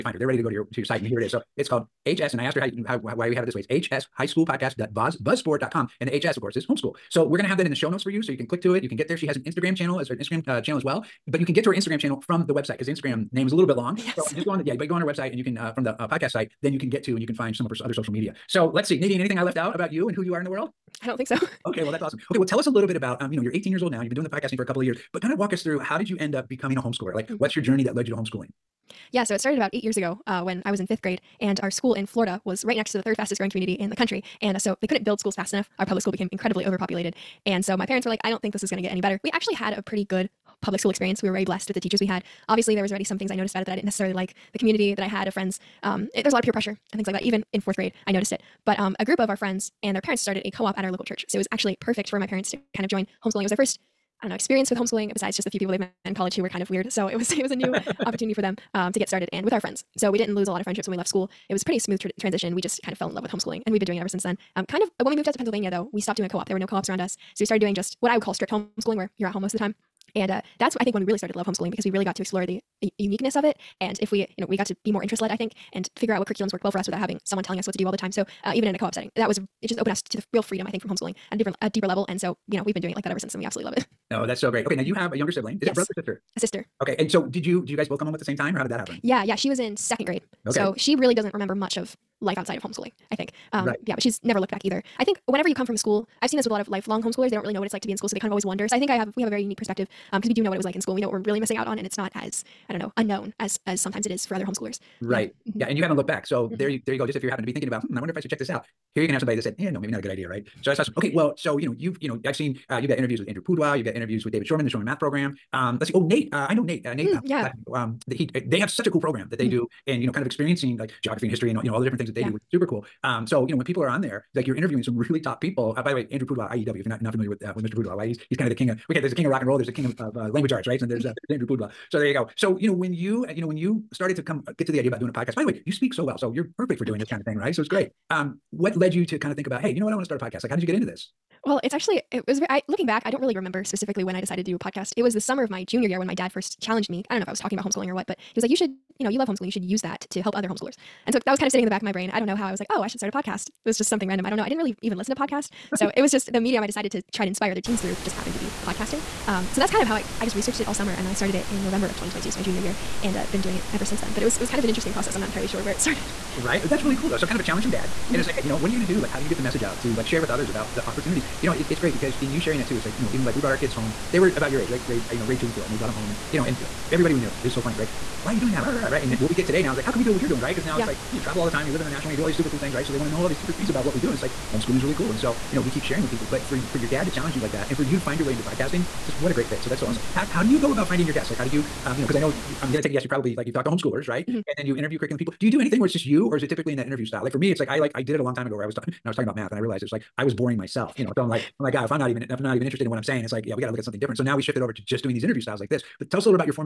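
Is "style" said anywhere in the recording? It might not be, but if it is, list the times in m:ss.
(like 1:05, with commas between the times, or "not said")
3:17, 3:25.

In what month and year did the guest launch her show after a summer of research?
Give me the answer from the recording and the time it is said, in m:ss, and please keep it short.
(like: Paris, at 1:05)
November 2022, at 2:41.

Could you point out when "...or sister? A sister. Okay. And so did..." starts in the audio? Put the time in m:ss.
1:25.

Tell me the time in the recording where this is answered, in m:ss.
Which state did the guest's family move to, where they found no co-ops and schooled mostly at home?
1:05.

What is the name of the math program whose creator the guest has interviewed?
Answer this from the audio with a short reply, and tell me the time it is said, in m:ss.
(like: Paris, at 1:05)
Shormann Math, at 1:54.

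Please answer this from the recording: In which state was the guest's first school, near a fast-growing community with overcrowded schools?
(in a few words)
Florida.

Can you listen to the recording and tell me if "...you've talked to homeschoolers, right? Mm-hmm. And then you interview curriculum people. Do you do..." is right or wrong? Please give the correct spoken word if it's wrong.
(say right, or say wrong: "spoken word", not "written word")
right.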